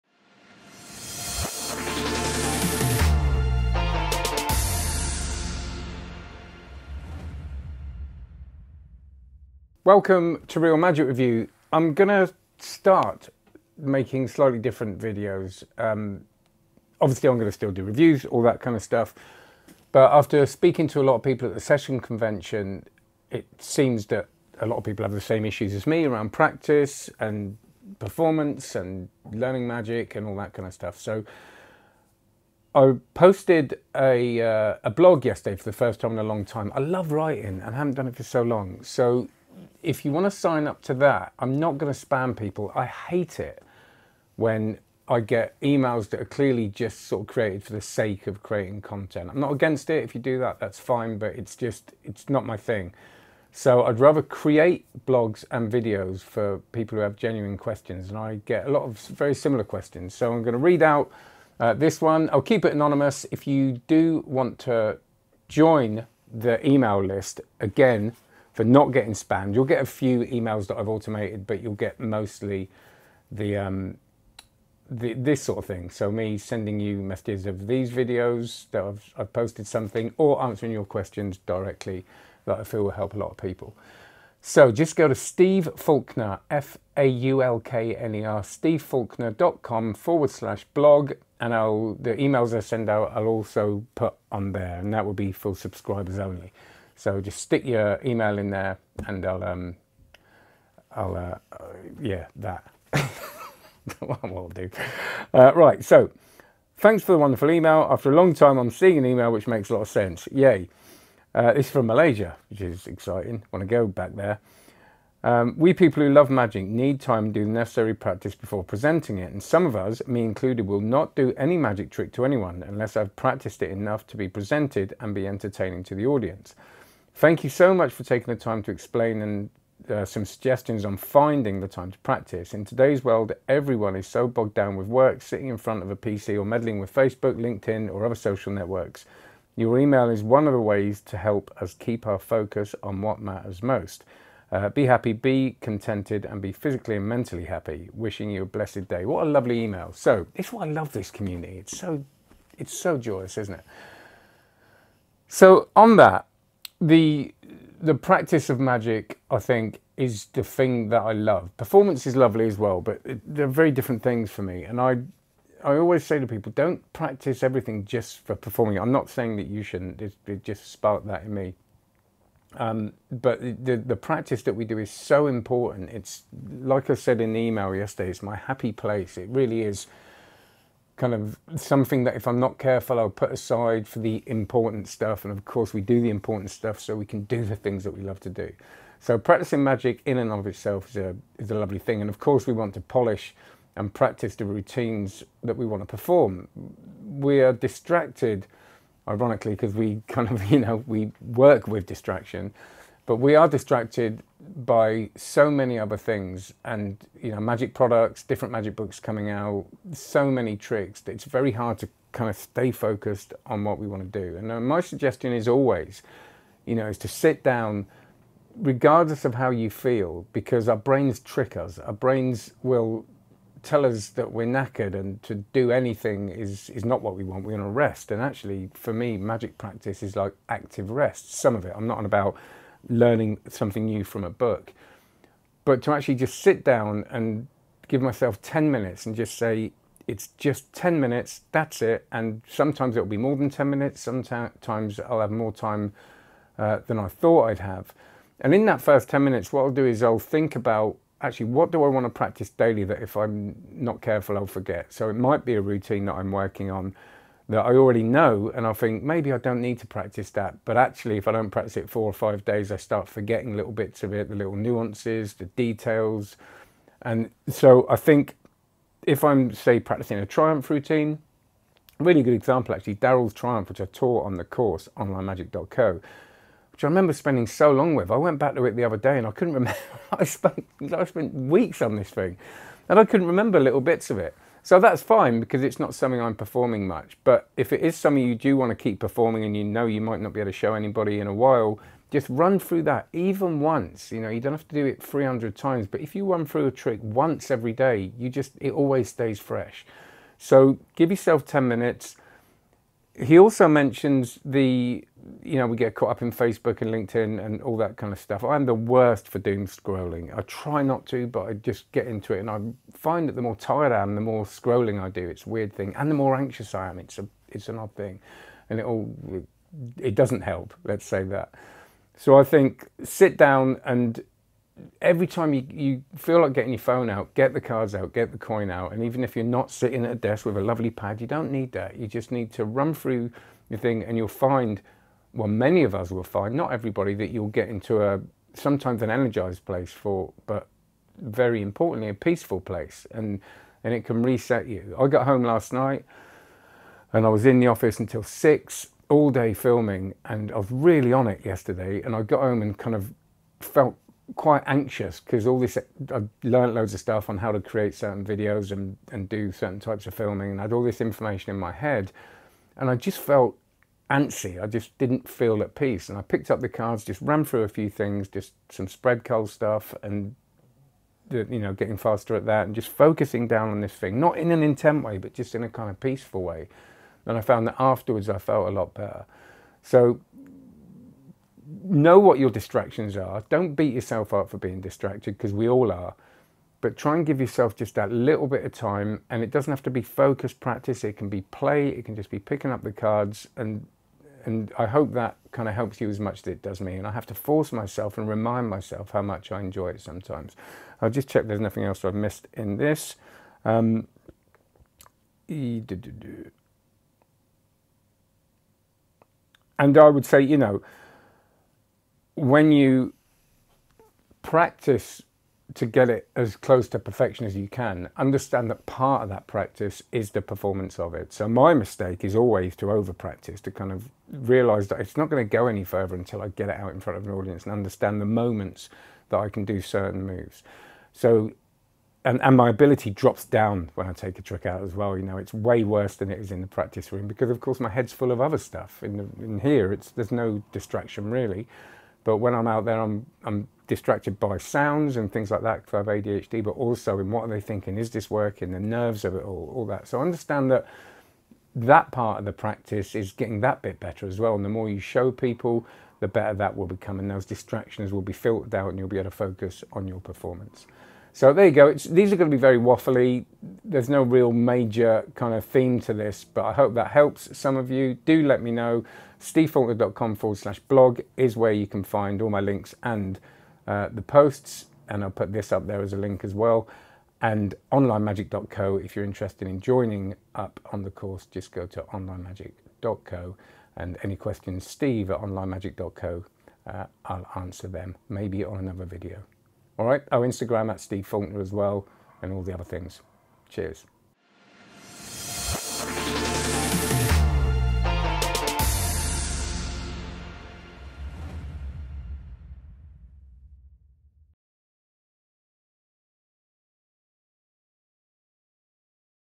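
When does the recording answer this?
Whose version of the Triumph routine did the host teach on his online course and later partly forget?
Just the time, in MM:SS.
04:32.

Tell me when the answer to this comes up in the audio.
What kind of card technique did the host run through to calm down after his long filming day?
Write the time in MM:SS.
06:08.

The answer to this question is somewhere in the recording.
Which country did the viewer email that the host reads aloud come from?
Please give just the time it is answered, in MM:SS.
01:51.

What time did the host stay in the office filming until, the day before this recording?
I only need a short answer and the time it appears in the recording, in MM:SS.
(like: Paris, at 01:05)
6, at 05:48.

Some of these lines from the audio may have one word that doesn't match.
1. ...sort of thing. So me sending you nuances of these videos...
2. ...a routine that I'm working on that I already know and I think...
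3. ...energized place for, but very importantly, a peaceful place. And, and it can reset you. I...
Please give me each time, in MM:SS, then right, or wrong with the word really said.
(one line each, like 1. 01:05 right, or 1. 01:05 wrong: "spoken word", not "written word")
1. 01:15 wrong: "messages", not "nuances"
2. 04:15 right
3. 05:39 right.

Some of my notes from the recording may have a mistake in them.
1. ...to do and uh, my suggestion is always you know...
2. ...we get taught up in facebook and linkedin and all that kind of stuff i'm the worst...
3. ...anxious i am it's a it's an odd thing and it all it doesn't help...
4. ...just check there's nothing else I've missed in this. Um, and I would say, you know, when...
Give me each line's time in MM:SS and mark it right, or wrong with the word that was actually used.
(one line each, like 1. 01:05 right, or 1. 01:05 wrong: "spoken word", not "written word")
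1. 03:34 right
2. 05:05 wrong: "caught", not "taught"
3. 05:16 right
4. 06:41 right.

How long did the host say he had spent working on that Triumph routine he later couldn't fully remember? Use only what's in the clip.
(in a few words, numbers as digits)
weeks.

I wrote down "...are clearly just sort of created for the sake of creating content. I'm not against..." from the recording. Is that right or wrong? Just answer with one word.
right.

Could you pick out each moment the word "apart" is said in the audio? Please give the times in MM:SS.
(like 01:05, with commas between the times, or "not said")
not said.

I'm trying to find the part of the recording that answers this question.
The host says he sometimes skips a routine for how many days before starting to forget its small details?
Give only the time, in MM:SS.
04:21.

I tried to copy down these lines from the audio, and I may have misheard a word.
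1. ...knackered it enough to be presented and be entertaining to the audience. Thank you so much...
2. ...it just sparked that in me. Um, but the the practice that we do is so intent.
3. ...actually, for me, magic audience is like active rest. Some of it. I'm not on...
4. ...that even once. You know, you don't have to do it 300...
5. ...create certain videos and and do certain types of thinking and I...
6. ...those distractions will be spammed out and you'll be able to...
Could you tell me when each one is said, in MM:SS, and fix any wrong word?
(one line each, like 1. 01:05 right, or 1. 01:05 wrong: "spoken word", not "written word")
1. 02:03 wrong: "practiced", not "knackered"
2. 02:50 wrong: "important", not "intent"
3. 03:48 wrong: "practice", not "audience"
4. 04:52 right
5. 05:57 wrong: "filming", not "thinking"
6. 07:37 wrong: "filtered", not "spammed".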